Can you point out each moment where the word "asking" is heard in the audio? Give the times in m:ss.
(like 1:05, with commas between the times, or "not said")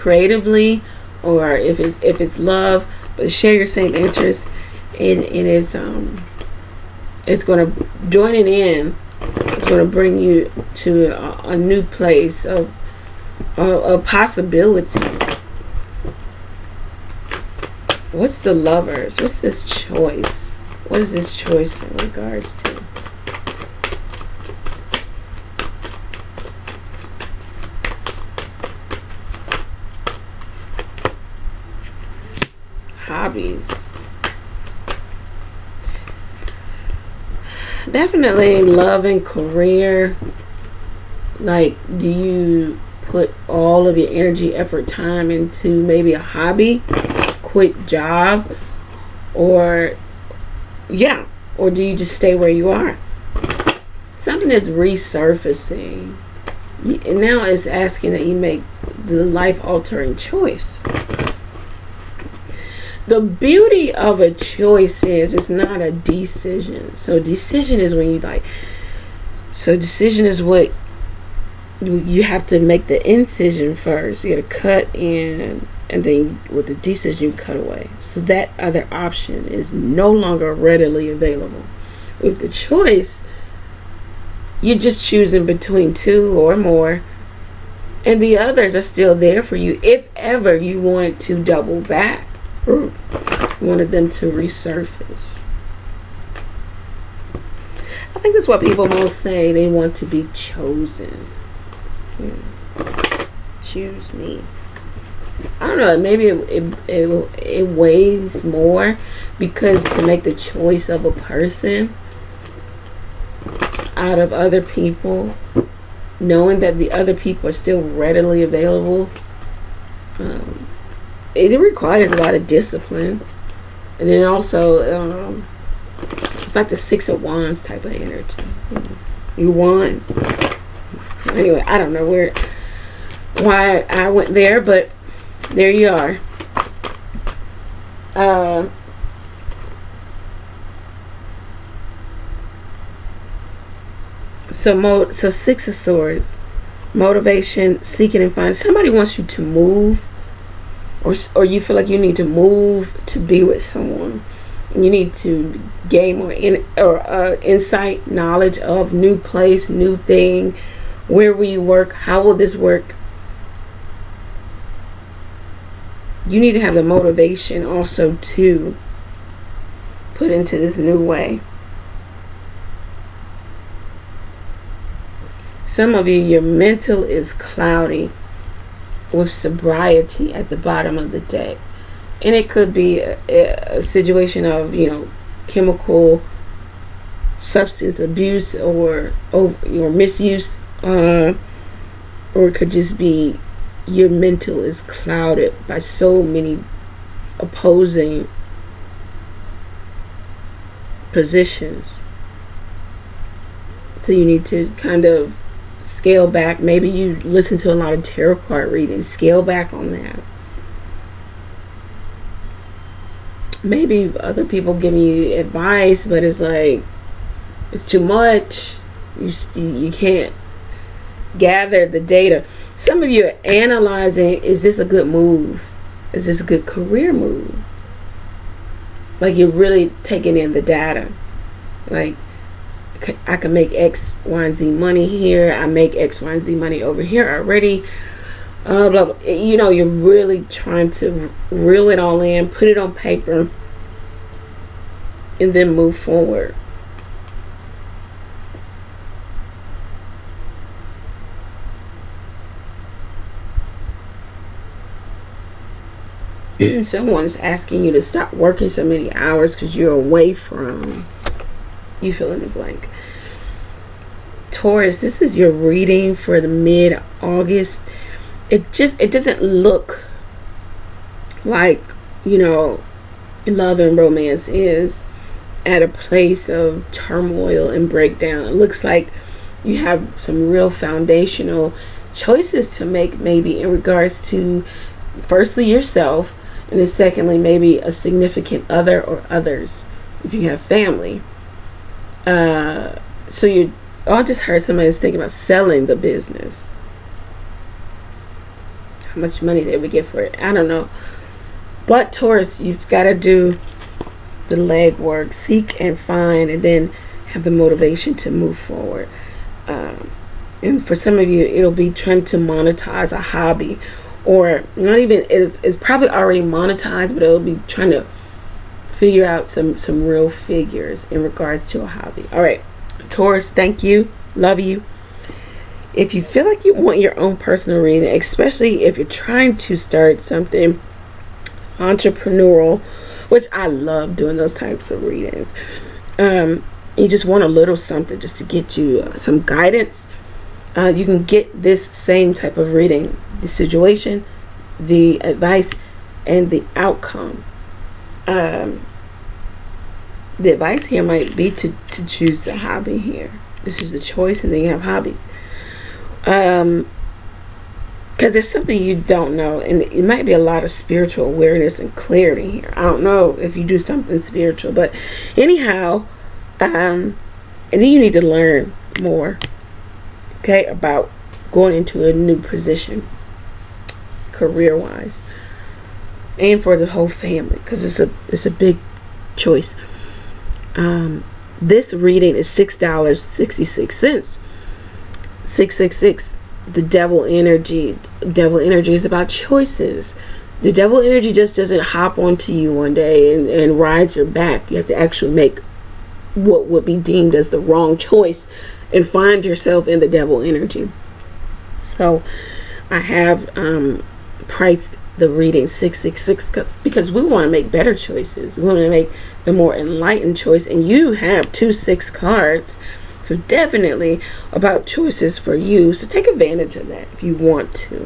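0:57, 4:17.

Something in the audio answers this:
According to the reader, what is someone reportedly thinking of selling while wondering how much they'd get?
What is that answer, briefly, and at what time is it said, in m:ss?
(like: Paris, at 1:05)
The business, at 4:55.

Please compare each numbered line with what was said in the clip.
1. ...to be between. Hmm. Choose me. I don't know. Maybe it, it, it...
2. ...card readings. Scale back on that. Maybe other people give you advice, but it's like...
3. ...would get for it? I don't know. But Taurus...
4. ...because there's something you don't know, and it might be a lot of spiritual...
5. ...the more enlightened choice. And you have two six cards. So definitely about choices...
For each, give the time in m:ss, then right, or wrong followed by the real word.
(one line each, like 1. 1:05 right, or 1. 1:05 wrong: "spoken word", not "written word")
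1. 1:39 wrong: "chosen", not "between"
2. 3:28 right
3. 4:59 right
4. 5:58 right
5. 6:49 right.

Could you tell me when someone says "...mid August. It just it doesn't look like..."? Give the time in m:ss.
4:26.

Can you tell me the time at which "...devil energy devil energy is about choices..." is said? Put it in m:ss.
6:26.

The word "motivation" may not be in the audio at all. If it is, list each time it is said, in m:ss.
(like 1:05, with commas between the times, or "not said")
2:26, 2:46, 5:07.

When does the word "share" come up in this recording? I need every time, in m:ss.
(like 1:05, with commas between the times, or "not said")
0:03.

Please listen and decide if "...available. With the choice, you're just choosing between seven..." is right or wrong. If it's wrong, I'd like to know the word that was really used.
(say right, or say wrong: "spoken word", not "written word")
wrong: "two", not "seven".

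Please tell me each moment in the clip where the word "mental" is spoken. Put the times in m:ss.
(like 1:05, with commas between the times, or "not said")
2:56, 3:14.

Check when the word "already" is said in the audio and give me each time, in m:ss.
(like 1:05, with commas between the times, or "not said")
3:57, 5:16.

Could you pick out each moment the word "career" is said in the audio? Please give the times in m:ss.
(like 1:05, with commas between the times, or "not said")
0:39, 3:46, 6:14.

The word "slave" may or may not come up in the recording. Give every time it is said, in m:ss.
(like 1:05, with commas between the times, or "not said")
not said.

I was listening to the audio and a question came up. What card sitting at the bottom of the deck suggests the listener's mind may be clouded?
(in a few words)
Sobriety.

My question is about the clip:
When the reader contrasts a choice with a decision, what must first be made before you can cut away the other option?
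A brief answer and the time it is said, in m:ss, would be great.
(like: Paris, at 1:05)
The incision, at 1:12.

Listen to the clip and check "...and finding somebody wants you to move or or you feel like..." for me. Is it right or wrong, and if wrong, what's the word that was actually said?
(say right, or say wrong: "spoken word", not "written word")
right.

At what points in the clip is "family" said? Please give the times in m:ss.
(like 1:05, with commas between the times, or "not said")
4:50, 6:17.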